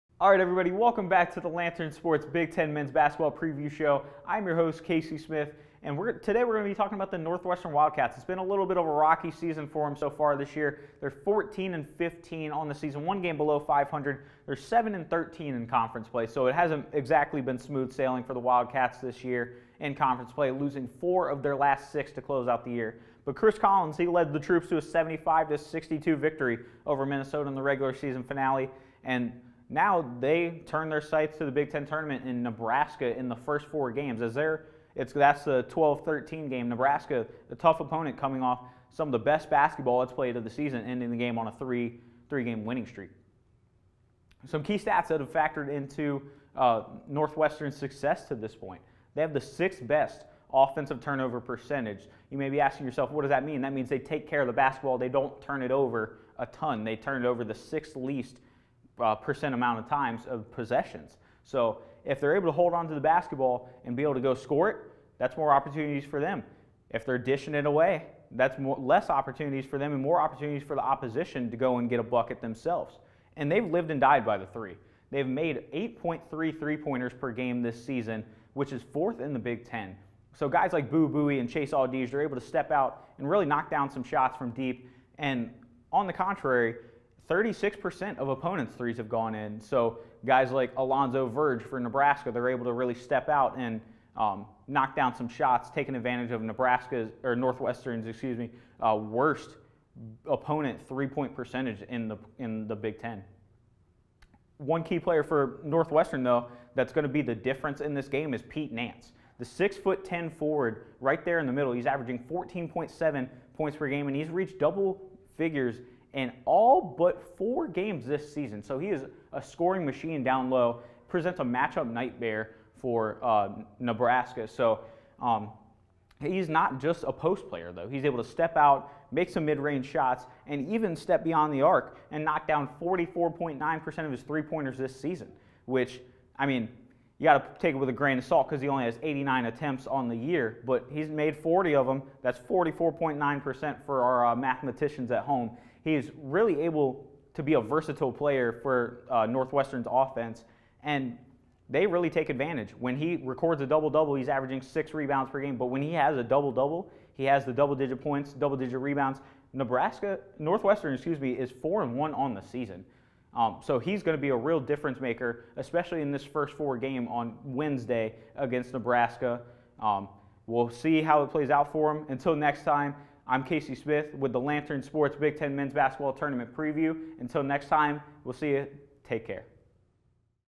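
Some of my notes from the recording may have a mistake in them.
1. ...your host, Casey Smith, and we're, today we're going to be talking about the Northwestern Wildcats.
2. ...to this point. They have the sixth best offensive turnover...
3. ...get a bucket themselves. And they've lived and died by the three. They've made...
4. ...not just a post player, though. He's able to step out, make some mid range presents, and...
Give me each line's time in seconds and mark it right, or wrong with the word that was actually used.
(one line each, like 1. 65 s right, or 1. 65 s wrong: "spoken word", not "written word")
1. 4 s right
2. 48 s right
3. 71 s right
4. 126 s wrong: "shots", not "presents".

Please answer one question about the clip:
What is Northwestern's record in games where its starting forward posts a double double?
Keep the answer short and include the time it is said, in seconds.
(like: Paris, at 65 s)
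4-1, at 161 s.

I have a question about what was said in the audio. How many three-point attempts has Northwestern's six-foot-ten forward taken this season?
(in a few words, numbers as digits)
89.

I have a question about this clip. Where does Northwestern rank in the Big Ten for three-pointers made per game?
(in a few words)
Fourth.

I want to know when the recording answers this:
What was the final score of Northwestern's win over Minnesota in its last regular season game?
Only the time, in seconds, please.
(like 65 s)
24 s.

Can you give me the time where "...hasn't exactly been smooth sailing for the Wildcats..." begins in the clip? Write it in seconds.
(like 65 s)
16 s.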